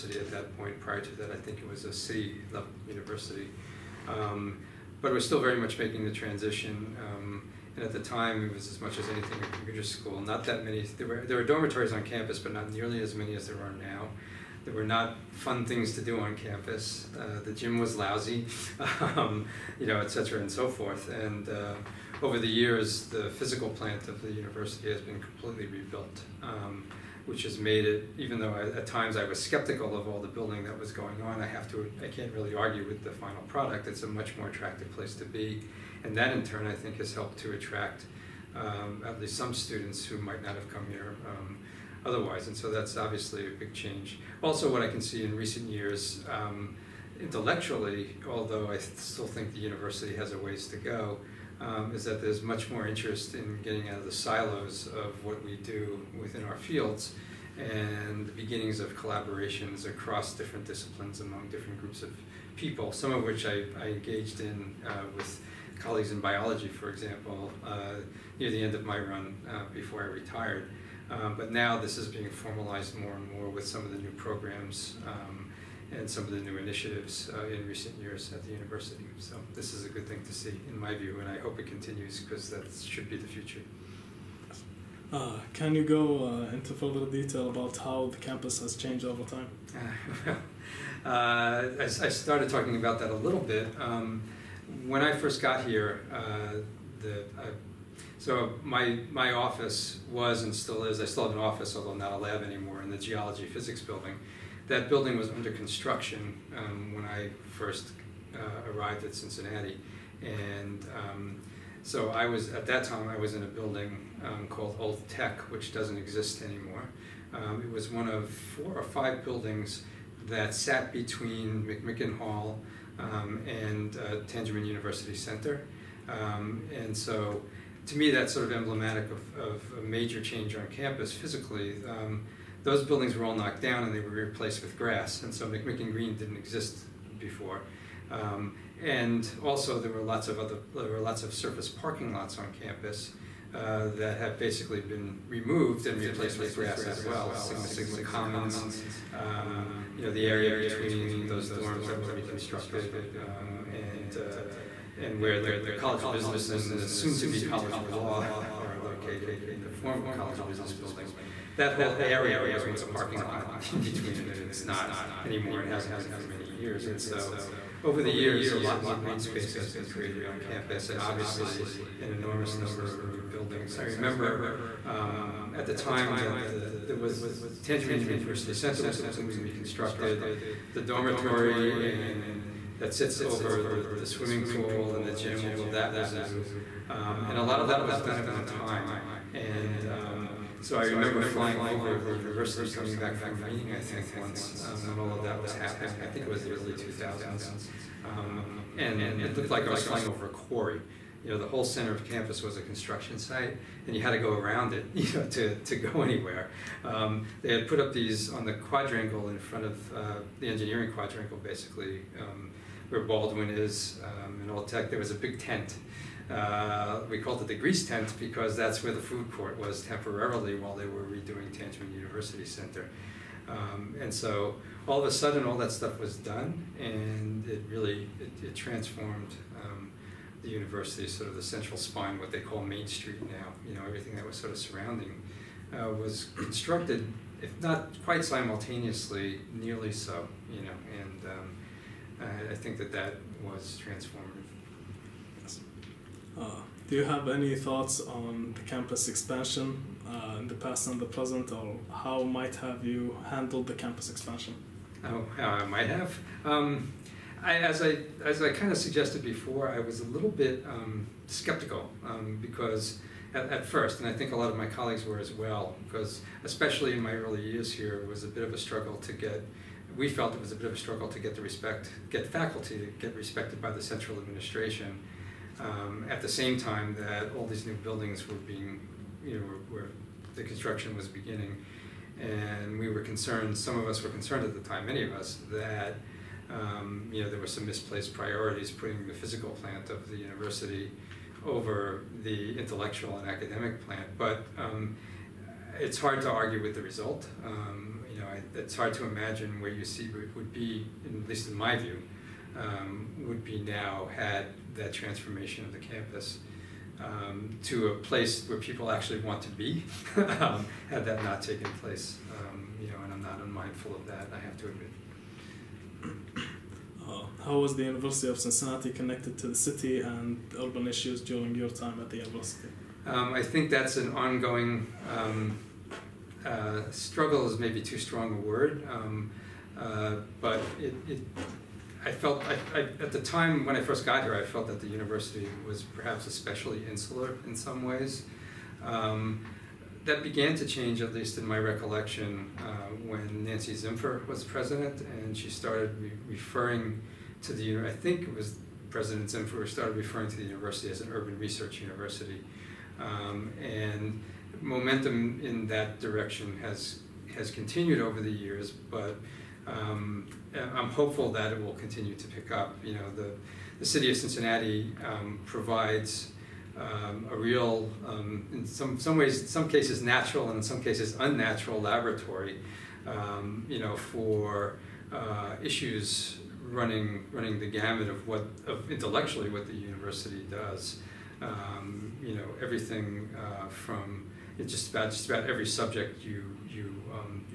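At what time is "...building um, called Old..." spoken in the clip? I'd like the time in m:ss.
1:53.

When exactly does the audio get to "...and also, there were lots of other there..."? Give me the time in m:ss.
2:18.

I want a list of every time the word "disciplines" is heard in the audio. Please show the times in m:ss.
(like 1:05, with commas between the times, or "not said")
1:00.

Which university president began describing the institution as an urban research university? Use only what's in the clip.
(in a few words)
Nancy Zimpher.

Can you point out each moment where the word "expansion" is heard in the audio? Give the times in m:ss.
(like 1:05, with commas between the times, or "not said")
4:09, 4:14.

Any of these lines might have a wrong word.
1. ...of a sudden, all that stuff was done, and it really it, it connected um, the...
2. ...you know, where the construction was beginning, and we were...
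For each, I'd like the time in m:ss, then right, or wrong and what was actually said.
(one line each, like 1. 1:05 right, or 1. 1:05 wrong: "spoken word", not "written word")
1. 3:44 wrong: "transformed", not "connected"
2. 4:39 right.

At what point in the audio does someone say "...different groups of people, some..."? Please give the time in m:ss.
1:01.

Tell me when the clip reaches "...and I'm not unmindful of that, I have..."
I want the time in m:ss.
5:13.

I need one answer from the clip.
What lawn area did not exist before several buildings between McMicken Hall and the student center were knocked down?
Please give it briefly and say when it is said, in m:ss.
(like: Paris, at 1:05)
McMicken Green, at 2:15.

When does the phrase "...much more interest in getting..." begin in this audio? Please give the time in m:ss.
0:52.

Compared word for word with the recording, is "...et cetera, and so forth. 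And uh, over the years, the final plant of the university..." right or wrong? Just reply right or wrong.
wrong.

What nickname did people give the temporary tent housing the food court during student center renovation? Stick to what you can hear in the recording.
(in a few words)
Grease Tent.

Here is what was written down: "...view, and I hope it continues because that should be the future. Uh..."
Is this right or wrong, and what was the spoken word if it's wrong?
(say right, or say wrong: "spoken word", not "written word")
right.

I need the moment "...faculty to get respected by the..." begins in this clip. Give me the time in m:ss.
4:32.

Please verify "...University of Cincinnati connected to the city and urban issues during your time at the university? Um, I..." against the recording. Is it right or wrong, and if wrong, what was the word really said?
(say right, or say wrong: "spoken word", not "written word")
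right.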